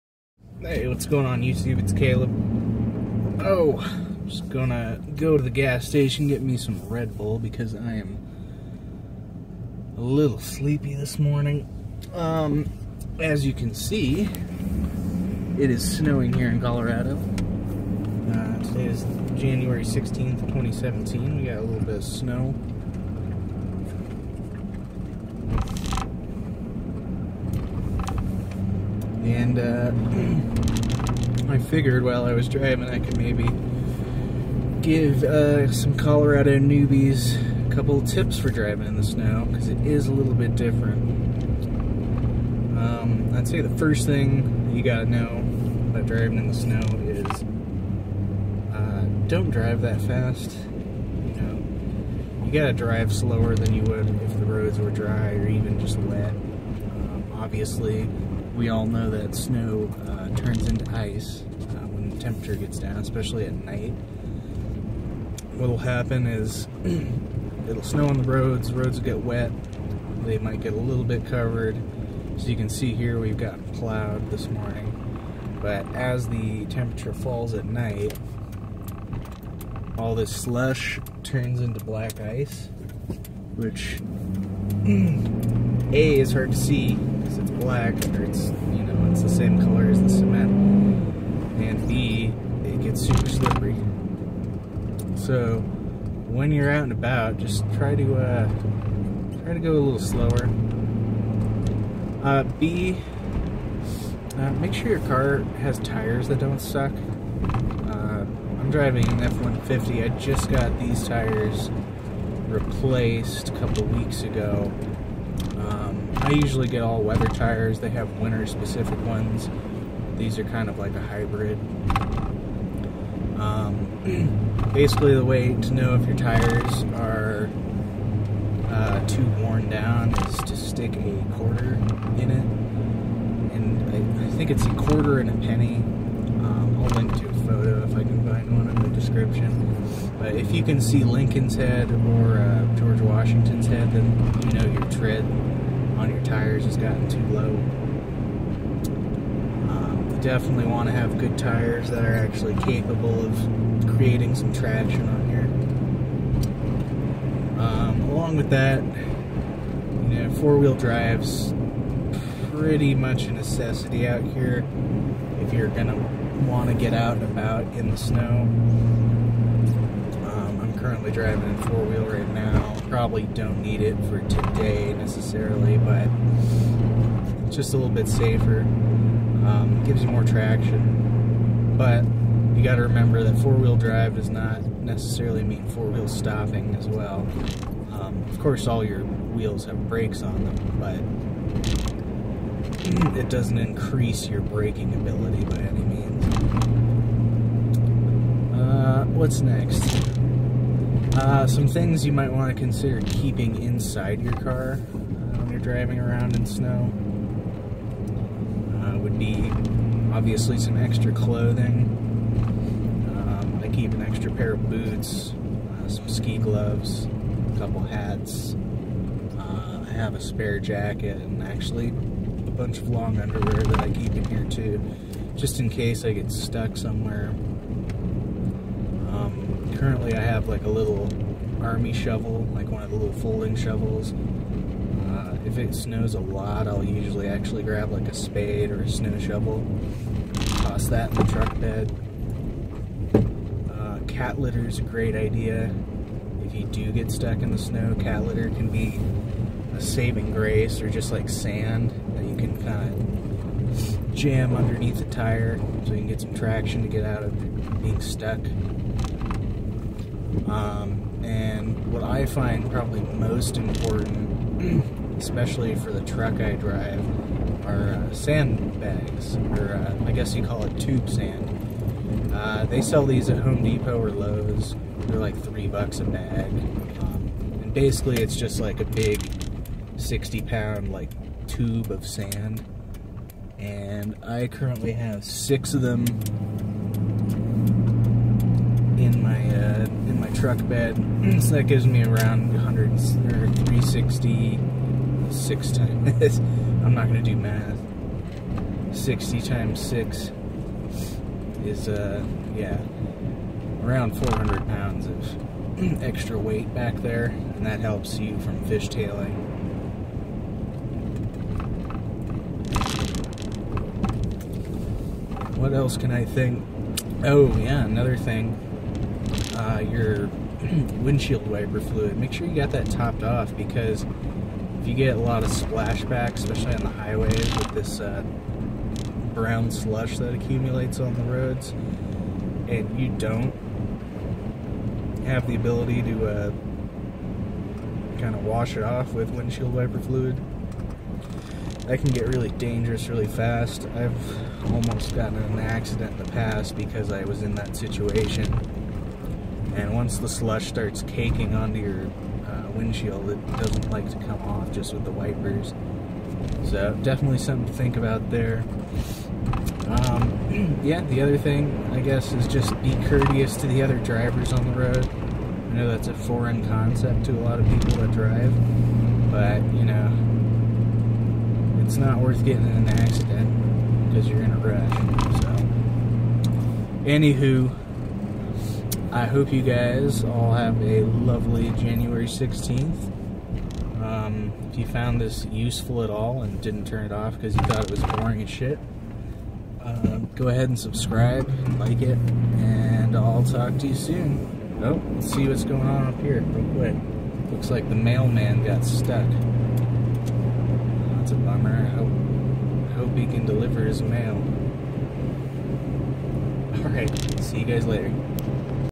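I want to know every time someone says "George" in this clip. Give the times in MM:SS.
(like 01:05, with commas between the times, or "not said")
02:22.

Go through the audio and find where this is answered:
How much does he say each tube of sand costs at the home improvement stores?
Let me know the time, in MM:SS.
04:35.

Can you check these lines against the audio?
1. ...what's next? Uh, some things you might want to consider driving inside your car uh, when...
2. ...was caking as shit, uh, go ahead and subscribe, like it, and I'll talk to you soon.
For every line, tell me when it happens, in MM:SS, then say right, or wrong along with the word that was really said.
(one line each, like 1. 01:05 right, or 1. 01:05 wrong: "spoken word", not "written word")
1. 03:19 wrong: "keeping", not "driving"
2. 06:27 wrong: "boring", not "caking".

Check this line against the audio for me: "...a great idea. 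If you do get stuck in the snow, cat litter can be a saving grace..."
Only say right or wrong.
right.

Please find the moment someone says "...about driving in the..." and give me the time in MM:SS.
00:45.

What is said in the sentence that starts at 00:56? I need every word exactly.
Um, obviously, we all know that snow uh, turns into ice uh, when the temperature gets down, especially at night.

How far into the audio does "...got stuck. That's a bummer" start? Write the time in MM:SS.
06:38.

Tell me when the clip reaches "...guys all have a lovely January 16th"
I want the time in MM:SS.
06:19.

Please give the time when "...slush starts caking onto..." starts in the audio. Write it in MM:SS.
05:50.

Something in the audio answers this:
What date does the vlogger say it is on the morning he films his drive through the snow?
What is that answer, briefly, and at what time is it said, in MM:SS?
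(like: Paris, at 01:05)
January 16th, 2017, at 00:19.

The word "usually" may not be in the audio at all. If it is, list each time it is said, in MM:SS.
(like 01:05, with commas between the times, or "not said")
01:56, 03:56.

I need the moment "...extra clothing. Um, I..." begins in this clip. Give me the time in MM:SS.
03:30.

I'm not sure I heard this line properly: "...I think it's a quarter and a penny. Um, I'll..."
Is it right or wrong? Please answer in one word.
right.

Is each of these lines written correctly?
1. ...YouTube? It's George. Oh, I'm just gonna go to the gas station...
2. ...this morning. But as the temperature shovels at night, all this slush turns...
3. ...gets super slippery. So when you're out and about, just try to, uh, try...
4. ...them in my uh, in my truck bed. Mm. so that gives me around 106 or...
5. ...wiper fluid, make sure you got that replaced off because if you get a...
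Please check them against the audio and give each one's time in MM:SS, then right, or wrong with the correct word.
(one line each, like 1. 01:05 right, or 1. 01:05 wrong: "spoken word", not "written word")
1. 00:01 wrong: "Caleb", not "George"
2. 01:14 wrong: "falls", not "shovels"
3. 01:32 right
4. 04:45 wrong: "100", not "106"
5. 05:21 wrong: "topped", not "replaced".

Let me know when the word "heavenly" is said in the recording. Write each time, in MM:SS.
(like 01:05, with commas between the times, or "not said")
not said.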